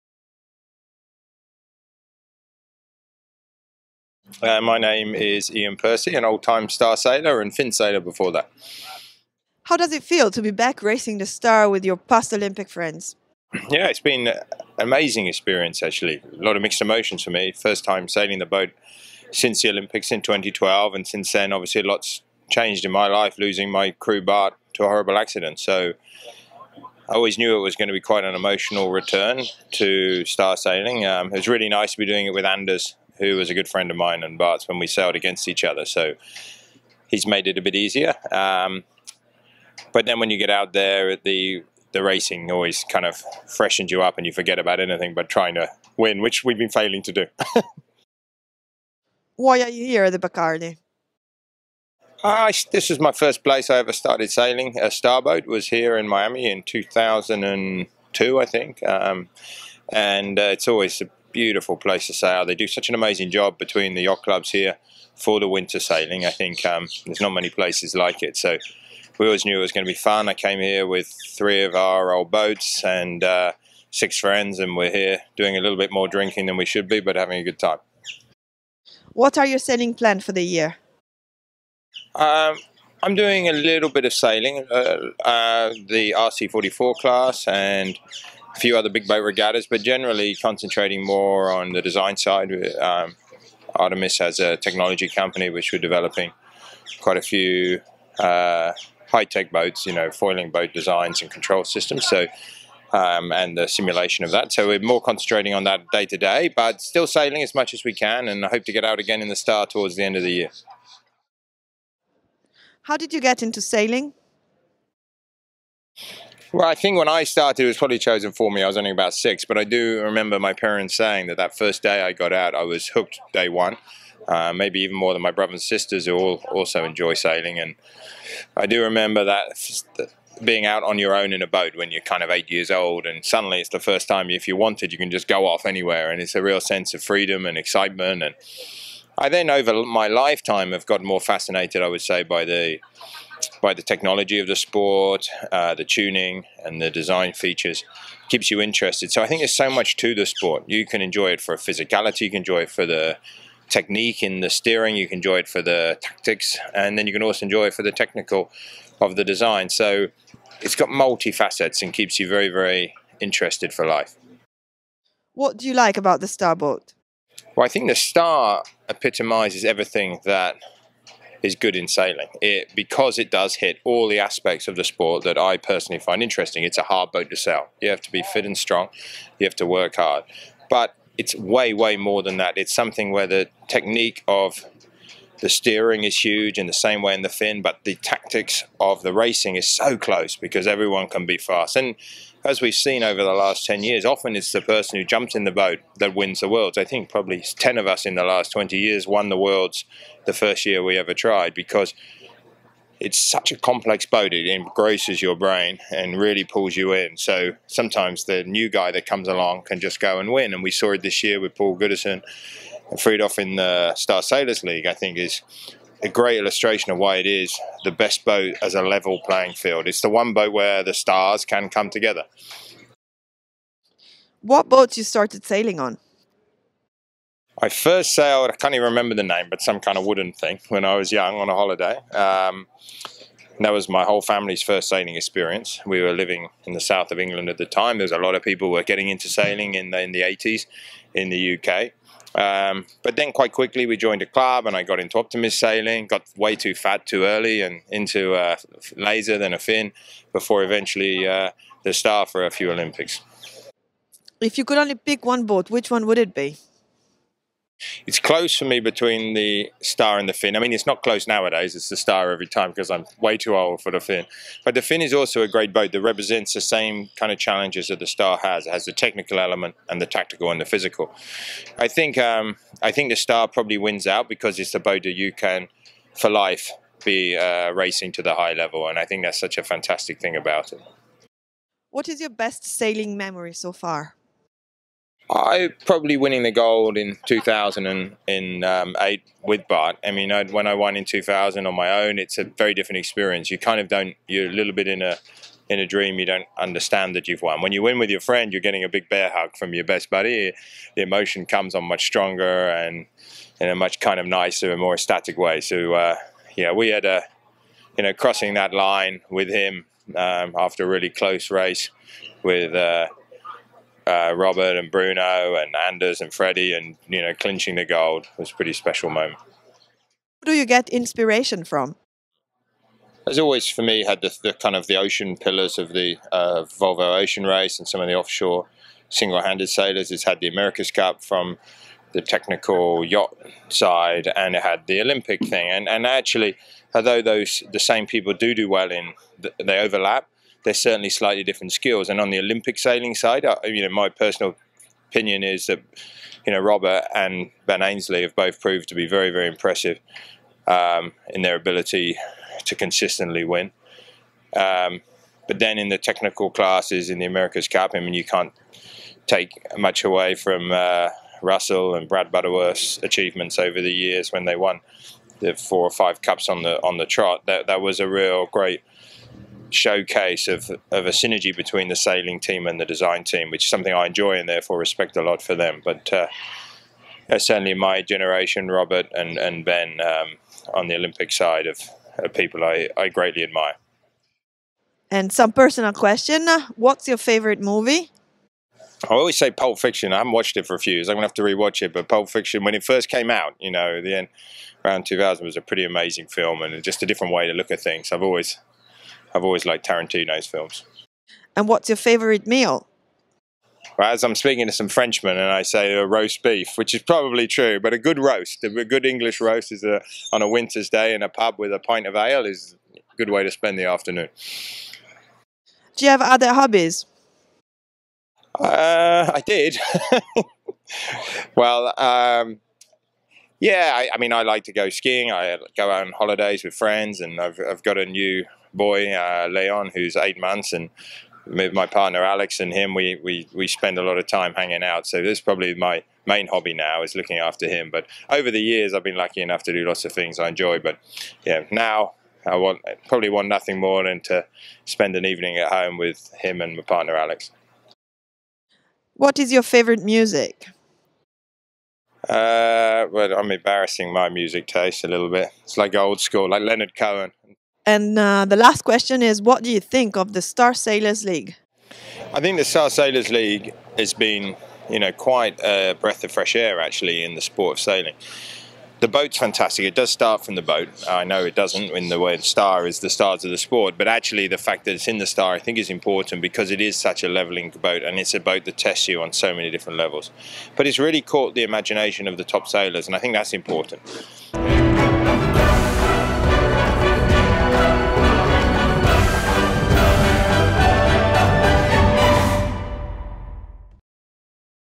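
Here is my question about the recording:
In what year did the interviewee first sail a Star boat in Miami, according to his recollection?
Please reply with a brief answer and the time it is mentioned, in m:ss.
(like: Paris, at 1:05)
2002, at 0:56.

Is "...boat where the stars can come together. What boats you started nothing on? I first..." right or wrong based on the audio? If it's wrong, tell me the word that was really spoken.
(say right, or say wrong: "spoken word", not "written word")
wrong: "sailing", not "nothing".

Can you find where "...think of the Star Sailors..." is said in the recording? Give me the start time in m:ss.
7:39.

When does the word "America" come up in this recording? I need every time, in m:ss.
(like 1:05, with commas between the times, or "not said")
5:30, 5:57.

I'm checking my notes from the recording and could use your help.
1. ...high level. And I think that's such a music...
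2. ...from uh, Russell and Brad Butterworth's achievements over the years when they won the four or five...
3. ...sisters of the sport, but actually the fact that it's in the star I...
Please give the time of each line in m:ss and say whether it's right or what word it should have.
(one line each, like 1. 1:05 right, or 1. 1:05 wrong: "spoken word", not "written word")
1. 4:38 wrong: "fantastic", not "music"
2. 6:00 right
3. 7:53 wrong: "stars", not "sisters".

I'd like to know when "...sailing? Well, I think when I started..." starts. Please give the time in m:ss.
1:53.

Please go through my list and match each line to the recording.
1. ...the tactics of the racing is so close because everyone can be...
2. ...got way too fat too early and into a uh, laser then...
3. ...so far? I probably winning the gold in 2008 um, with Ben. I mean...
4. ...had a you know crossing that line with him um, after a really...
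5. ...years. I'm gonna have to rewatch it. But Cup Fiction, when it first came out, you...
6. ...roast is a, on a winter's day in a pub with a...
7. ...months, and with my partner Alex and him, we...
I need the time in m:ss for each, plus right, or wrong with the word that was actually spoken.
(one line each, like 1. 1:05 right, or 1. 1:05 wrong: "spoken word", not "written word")
1. 3:07 right
2. 4:06 right
3. 4:43 wrong: "Bart", not "Ben"
4. 5:06 right
5. 6:30 wrong: "Pulp", not "Cup"
6. 6:49 right
7. 7:10 right.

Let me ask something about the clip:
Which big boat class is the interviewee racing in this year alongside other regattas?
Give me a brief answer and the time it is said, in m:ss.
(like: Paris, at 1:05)
RC44, at 1:26.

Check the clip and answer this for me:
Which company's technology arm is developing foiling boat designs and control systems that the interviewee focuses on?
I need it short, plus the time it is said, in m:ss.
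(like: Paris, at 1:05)
Artemis, at 1:33.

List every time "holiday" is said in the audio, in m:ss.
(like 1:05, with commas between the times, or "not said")
3:51, 7:06.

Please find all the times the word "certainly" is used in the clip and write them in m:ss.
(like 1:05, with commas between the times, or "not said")
5:40, 6:17.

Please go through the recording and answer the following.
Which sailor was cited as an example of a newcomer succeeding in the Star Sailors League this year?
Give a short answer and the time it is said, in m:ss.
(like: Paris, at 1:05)
Paul Goodison, at 3:31.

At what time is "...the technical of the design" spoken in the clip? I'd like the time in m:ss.
2:37.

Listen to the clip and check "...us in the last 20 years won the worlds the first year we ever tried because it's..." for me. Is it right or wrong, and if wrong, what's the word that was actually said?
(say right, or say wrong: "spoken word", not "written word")
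right.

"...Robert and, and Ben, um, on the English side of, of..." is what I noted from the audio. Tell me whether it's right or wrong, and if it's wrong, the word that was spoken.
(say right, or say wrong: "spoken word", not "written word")
wrong: "Olympic", not "English".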